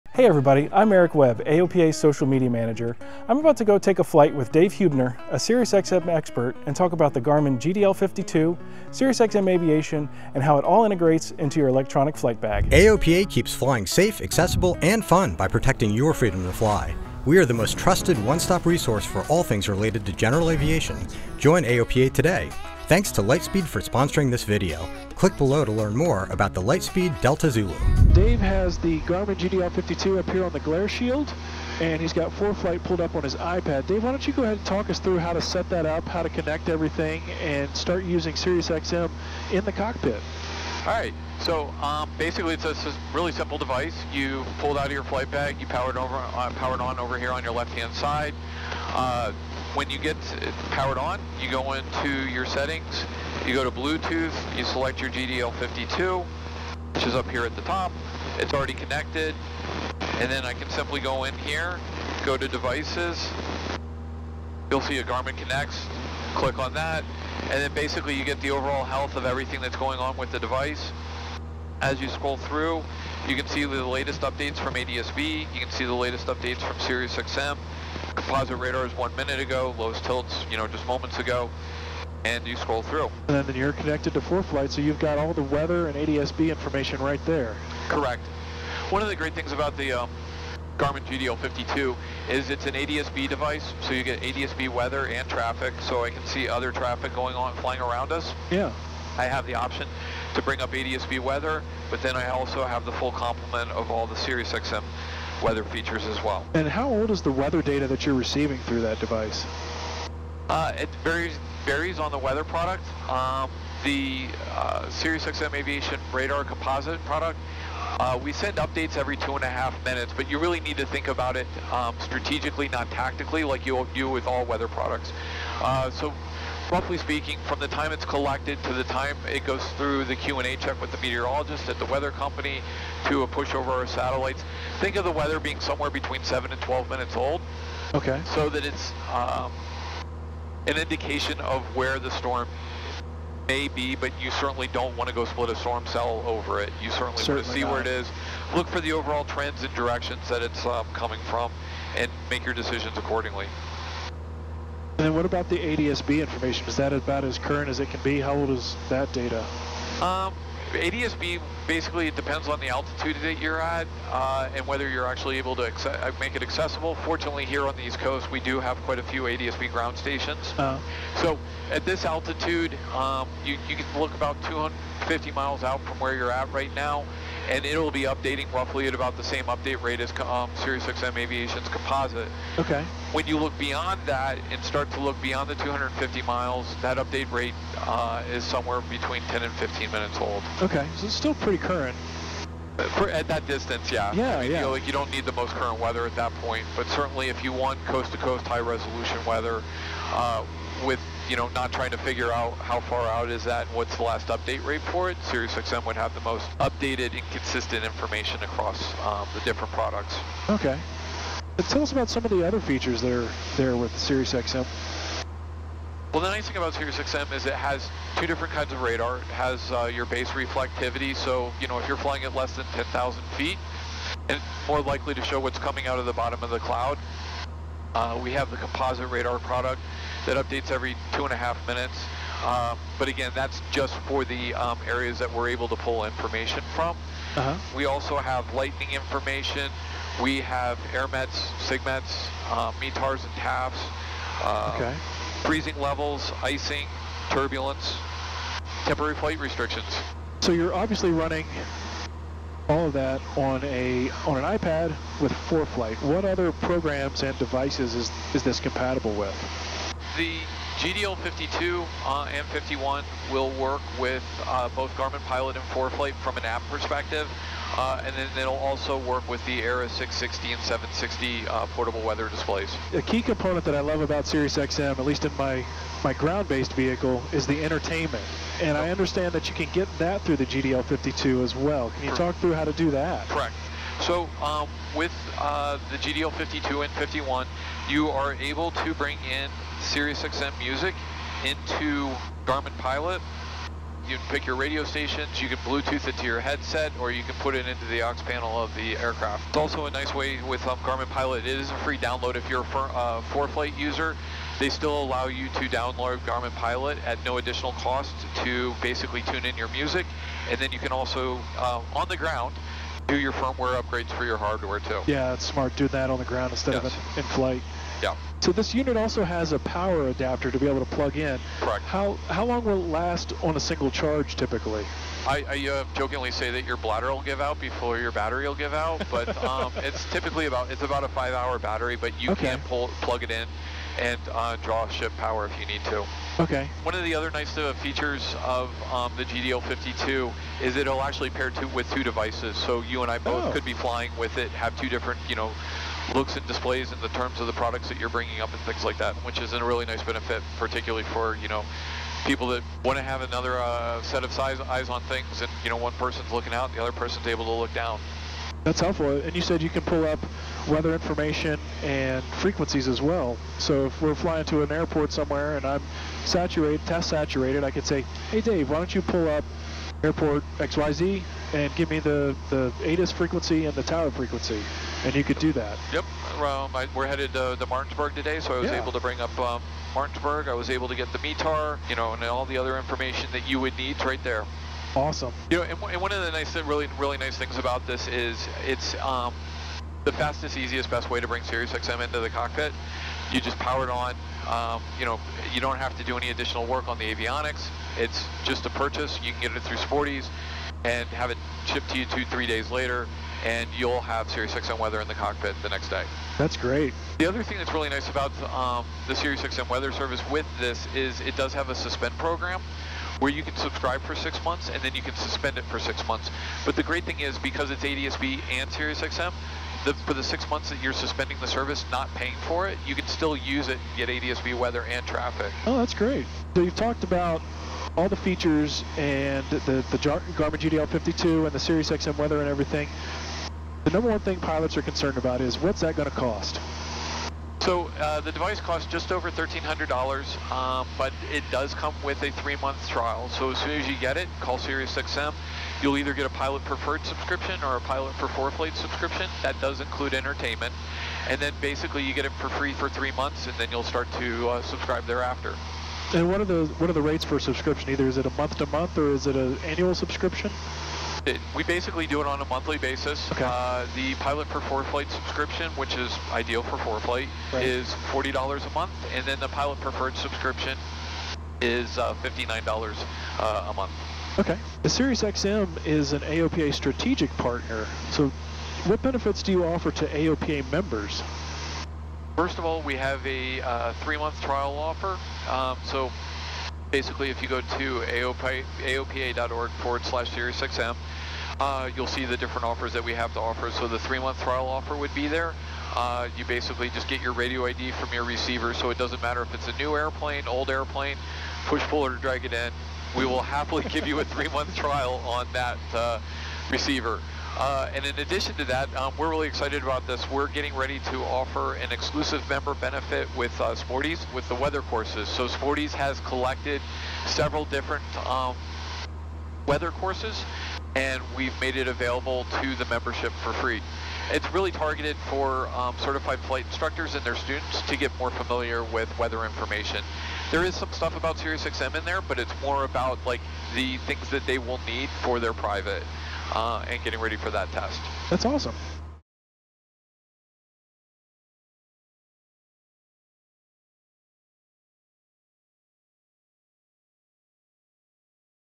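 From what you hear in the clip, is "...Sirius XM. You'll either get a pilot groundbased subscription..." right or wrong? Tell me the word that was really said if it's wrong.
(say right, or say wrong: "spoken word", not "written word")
wrong: "preferred", not "groundbased".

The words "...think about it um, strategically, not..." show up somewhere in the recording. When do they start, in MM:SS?
02:00.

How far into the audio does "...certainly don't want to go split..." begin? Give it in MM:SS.
02:24.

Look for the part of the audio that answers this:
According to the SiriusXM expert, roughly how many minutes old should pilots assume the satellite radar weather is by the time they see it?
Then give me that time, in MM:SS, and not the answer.
02:15.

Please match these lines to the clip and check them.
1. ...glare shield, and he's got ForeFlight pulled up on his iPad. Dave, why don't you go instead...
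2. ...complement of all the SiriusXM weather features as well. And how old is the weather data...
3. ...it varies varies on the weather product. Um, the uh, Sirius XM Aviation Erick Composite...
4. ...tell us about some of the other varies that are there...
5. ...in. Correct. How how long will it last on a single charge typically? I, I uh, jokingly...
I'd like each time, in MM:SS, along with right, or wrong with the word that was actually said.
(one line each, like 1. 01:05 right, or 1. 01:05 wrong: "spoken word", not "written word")
1. 00:30 wrong: "ahead", not "instead"
2. 01:43 right
3. 01:50 wrong: "Radar", not "Erick"
4. 03:31 wrong: "features", not "varies"
5. 05:21 right.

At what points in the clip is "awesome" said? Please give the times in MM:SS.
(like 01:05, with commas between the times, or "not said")
06:24, 08:58.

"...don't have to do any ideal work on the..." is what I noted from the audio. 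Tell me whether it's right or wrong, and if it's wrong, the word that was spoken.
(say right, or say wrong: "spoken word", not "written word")
wrong: "additional", not "ideal".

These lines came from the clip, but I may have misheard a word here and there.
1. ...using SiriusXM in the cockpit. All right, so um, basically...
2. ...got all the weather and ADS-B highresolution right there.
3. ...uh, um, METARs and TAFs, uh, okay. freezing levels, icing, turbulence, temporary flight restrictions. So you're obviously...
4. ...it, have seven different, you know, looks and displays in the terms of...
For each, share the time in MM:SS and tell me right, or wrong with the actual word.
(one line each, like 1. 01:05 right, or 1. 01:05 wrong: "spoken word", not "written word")
1. 00:38 right
2. 01:24 wrong: "information", not "highresolution"
3. 04:02 right
4. 05:44 wrong: "two", not "seven".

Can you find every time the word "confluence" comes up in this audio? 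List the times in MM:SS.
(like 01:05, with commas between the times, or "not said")
not said.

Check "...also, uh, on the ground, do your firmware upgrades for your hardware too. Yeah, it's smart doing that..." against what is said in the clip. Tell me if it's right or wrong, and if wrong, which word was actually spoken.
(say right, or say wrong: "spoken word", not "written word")
right.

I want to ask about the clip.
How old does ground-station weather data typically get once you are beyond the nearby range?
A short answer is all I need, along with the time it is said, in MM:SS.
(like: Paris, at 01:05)
10 to 15 minutes, at 03:08.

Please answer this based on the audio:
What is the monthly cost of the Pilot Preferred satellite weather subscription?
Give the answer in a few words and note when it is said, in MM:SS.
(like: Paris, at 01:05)
$59, at 07:52.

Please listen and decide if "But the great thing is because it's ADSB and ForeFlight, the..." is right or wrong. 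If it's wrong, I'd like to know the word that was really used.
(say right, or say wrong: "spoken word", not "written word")
wrong: "SiriusXM", not "ForeFlight".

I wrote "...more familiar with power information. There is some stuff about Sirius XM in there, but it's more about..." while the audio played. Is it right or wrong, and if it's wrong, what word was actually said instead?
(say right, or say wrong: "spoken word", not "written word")
wrong: "weather", not "power".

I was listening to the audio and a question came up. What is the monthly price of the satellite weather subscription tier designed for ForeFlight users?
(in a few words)
$40.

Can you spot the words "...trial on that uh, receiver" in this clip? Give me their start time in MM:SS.
08:24.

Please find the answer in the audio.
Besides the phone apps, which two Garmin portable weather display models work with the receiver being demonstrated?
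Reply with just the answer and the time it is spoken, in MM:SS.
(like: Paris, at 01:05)
aera 660 and 760, at 04:29.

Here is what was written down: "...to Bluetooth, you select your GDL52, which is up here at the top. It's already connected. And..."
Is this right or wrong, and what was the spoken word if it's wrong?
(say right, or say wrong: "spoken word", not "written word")
right.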